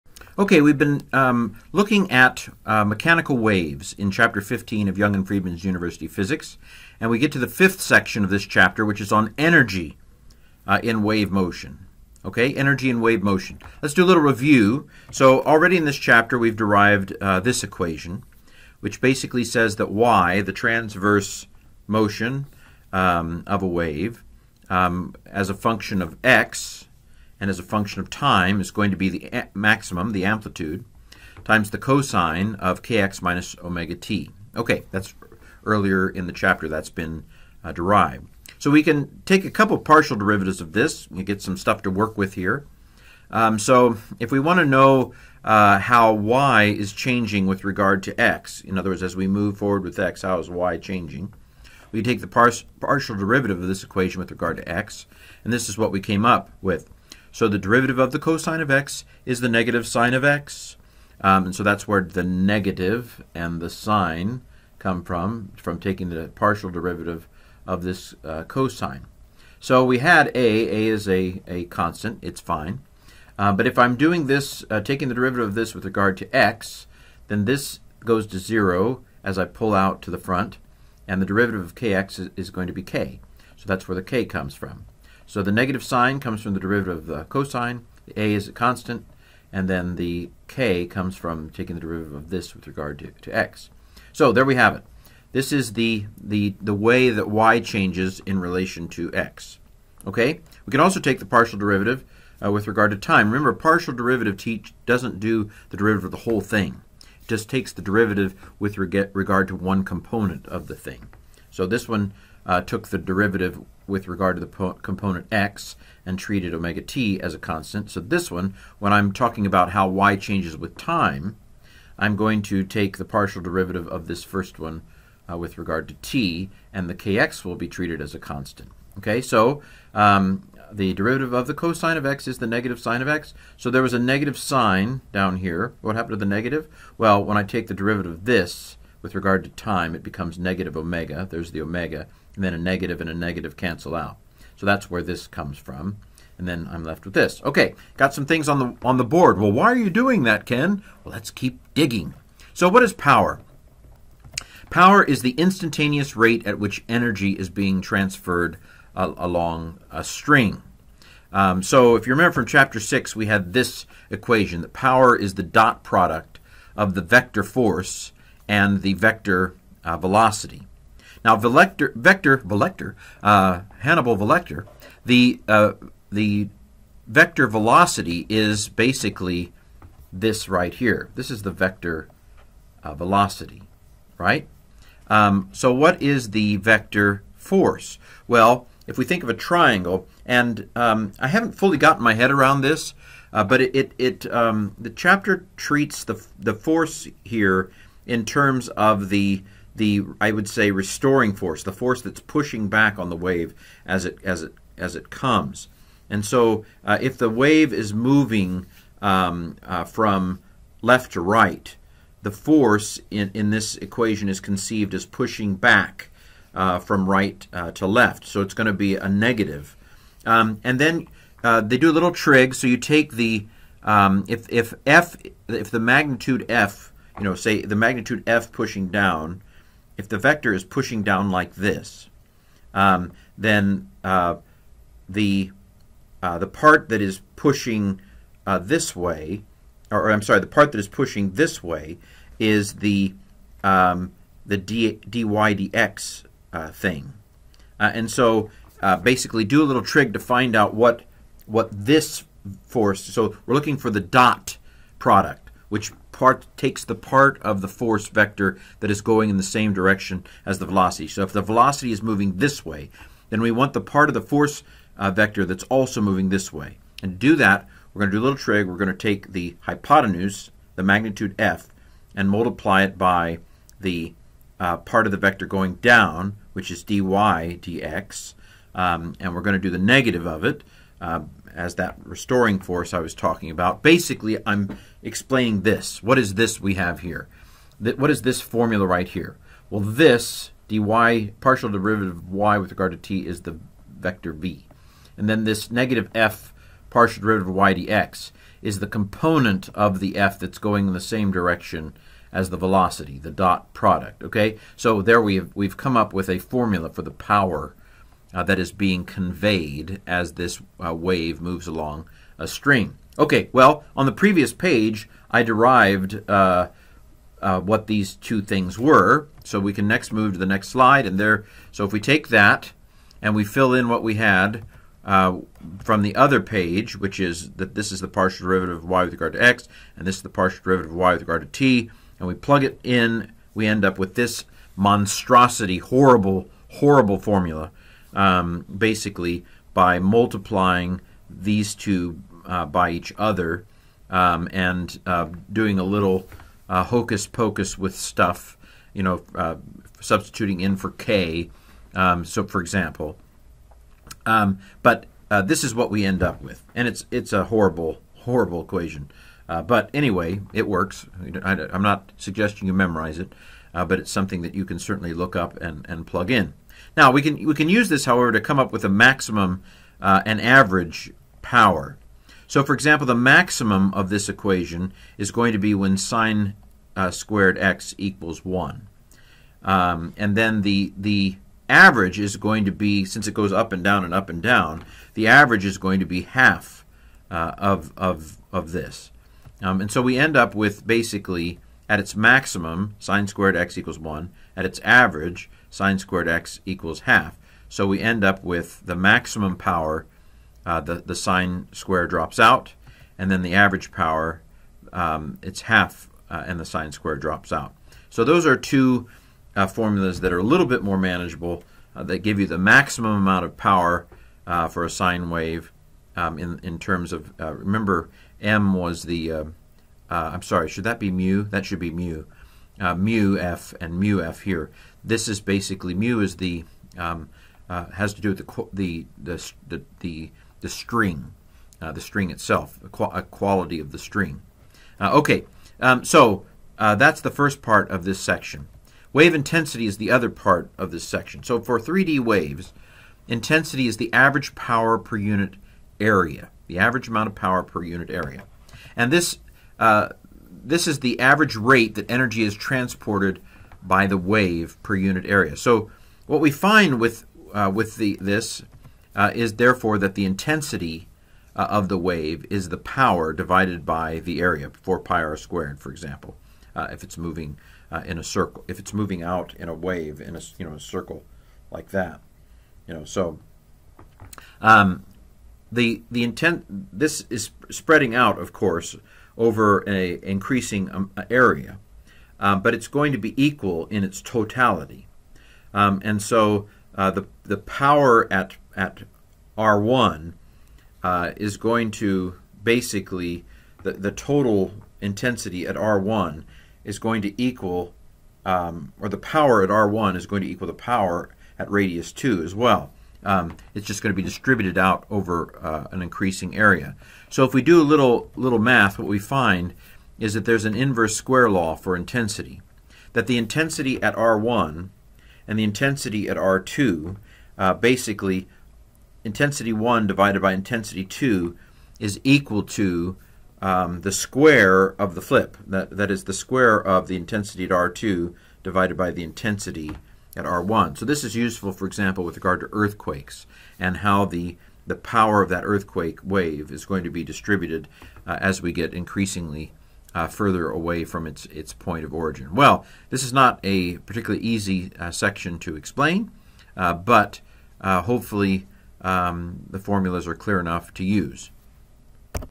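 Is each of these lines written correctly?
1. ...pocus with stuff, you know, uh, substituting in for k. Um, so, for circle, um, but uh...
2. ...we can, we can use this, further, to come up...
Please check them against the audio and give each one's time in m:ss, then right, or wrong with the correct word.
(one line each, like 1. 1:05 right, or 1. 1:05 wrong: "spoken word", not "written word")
1. 5:47 wrong: "example", not "circle"
2. 6:07 wrong: "however", not "further".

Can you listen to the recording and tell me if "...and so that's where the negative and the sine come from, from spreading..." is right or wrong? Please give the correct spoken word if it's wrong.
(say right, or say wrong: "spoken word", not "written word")
wrong: "taking", not "spreading".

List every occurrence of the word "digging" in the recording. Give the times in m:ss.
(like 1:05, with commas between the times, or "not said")
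2:31.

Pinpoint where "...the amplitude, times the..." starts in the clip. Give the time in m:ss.
0:30.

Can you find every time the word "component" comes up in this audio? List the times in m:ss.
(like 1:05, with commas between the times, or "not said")
1:49, 1:54, 4:58.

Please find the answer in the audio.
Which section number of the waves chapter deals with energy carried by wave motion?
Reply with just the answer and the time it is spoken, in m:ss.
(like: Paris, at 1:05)
fifth, at 0:07.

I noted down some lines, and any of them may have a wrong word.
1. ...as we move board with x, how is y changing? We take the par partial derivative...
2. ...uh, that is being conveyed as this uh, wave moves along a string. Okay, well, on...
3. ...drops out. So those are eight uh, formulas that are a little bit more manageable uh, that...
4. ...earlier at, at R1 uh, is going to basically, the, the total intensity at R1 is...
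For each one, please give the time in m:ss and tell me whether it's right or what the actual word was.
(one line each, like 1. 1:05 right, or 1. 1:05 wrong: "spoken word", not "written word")
1. 0:49 wrong: "forward", not "board"
2. 5:08 right
3. 6:47 wrong: "two", not "eight"
4. 8:07 wrong: "power", not "earlier".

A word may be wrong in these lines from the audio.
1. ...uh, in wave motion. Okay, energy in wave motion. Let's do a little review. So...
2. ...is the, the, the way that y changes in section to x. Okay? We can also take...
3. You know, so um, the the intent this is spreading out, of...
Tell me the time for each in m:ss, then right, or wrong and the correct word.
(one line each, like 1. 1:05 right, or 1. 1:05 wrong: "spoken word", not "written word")
1. 0:10 right
2. 1:35 wrong: "relation", not "section"
3. 7:52 right.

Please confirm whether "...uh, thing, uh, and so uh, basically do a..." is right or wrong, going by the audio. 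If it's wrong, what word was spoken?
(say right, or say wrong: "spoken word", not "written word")
right.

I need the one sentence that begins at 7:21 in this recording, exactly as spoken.
So for 3D waves, intensity is the average power per unit area, the average amount of power per unit area.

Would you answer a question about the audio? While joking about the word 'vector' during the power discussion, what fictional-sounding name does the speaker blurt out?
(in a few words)
Hannibal Velector.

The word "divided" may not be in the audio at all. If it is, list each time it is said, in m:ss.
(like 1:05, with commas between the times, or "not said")
7:43, 8:40, 8:48.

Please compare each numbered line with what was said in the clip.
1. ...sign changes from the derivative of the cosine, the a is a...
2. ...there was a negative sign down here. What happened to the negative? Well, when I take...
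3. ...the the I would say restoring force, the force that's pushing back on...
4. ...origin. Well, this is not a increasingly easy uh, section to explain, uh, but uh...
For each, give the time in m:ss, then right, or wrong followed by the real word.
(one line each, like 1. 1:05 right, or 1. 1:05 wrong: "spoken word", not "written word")
1. 1:25 wrong: "comes", not "changes"
2. 2:13 right
3. 3:19 right
4. 9:02 wrong: "particularly", not "increasingly".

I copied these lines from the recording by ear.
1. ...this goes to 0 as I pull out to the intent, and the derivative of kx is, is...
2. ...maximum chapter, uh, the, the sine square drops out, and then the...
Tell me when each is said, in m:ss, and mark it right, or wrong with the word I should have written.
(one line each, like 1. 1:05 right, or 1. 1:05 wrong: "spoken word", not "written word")
1. 1:17 wrong: "front", not "intent"
2. 6:38 wrong: "power", not "chapter".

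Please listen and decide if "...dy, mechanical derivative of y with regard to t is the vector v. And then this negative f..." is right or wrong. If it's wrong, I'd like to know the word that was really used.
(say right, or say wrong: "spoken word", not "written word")
wrong: "partial", not "mechanical".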